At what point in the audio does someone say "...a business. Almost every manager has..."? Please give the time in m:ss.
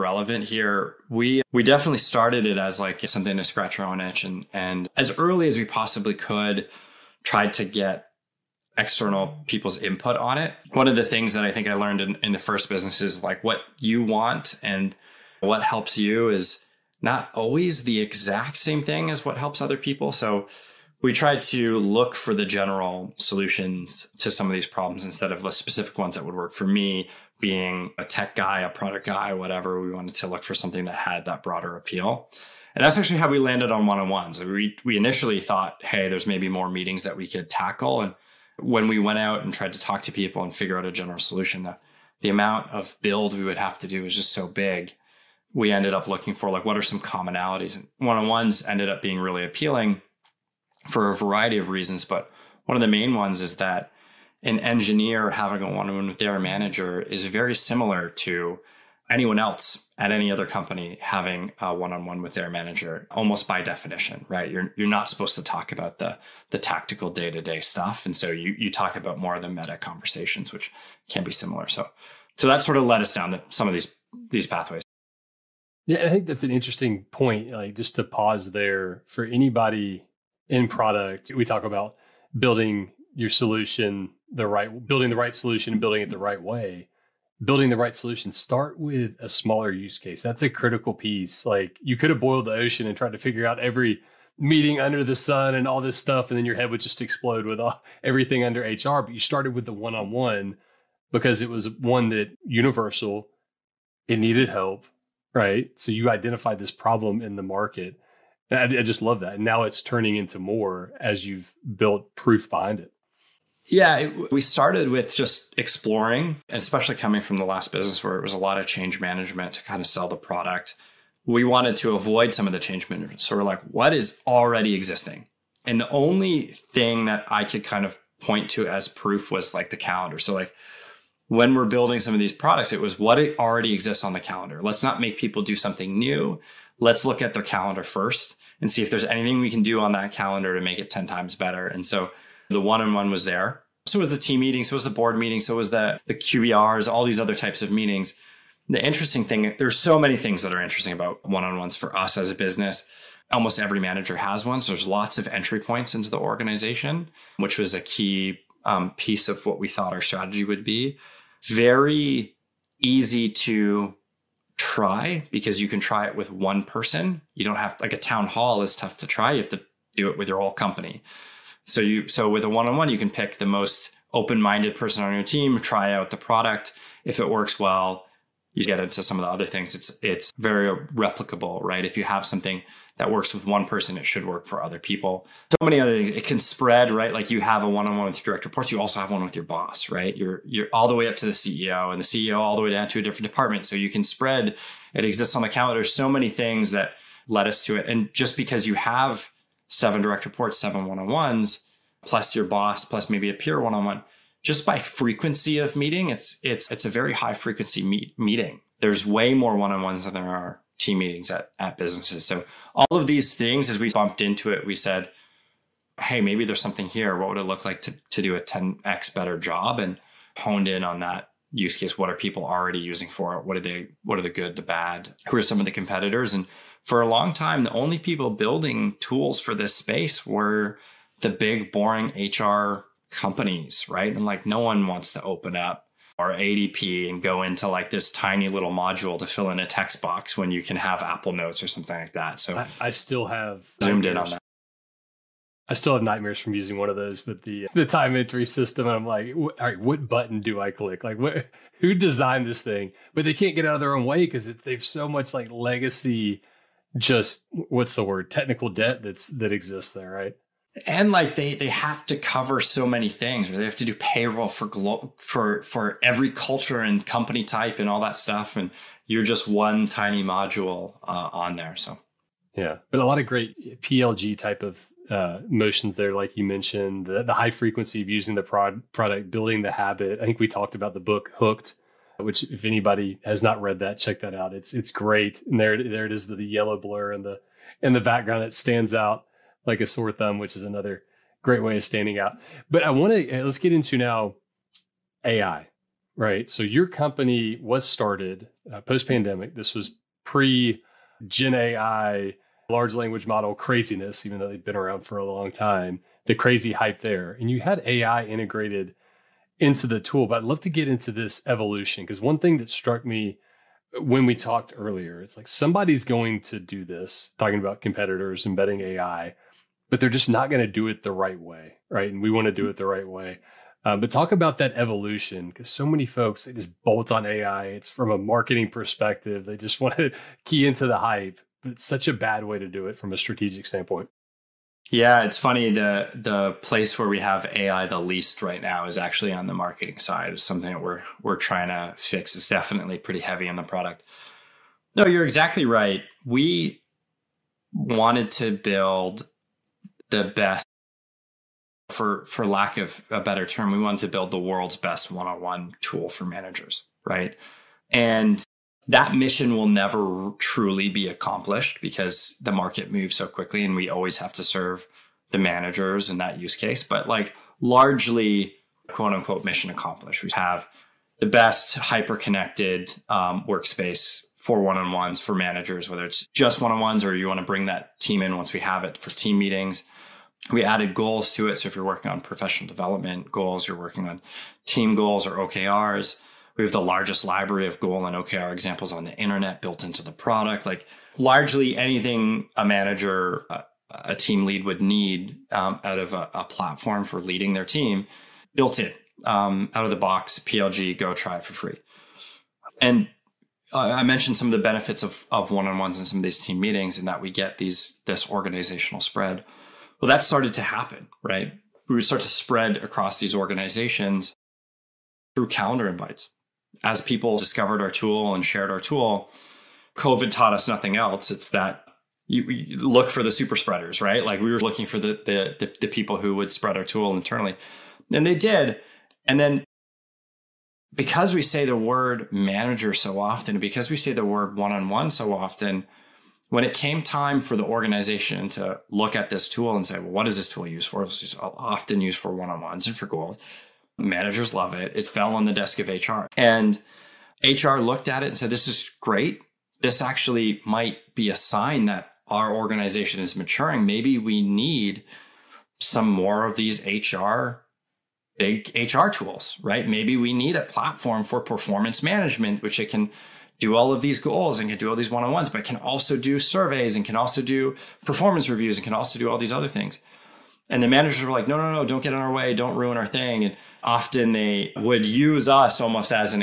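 2:32.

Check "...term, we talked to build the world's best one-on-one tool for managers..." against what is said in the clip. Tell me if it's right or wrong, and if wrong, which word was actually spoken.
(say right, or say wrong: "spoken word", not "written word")
wrong: "wanted", not "talked".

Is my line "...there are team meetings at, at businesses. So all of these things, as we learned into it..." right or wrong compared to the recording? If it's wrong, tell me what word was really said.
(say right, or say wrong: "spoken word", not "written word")
wrong: "bumped", not "learned".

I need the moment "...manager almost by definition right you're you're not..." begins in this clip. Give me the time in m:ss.
1:02.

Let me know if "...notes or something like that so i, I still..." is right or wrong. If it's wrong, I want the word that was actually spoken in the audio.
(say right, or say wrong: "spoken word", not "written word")
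right.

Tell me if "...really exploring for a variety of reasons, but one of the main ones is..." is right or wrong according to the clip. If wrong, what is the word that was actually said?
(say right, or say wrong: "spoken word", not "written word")
wrong: "appealing", not "exploring".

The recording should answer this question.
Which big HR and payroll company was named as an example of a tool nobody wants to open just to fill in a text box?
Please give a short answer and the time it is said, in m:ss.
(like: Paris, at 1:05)
ADP, at 3:56.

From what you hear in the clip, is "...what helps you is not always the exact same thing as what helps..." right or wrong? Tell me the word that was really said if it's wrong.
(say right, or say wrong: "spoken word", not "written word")
right.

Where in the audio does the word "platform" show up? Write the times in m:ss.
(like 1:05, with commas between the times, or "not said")
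6:36, 7:40.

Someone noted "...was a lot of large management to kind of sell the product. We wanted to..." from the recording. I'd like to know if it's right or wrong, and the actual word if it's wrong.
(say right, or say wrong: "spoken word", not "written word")
wrong: "change", not "large".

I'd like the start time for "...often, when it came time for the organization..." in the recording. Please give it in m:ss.
7:15.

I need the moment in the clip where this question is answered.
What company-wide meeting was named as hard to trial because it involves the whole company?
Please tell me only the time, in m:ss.
2:47.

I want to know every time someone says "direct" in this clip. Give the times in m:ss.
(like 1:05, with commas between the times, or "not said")
3:08, 3:20.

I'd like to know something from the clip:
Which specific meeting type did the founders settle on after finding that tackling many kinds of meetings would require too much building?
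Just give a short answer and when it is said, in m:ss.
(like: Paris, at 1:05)
One-on-ones, at 0:33.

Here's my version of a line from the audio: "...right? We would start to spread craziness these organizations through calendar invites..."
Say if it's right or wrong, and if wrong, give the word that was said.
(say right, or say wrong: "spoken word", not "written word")
wrong: "across", not "craziness".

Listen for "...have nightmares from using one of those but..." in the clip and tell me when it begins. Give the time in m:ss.
4:05.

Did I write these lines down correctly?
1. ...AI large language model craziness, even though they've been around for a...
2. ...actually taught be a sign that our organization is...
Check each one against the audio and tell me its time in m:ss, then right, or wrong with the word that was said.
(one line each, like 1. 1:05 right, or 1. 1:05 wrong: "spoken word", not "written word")
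1. 5:01 right
2. 7:30 wrong: "might", not "taught".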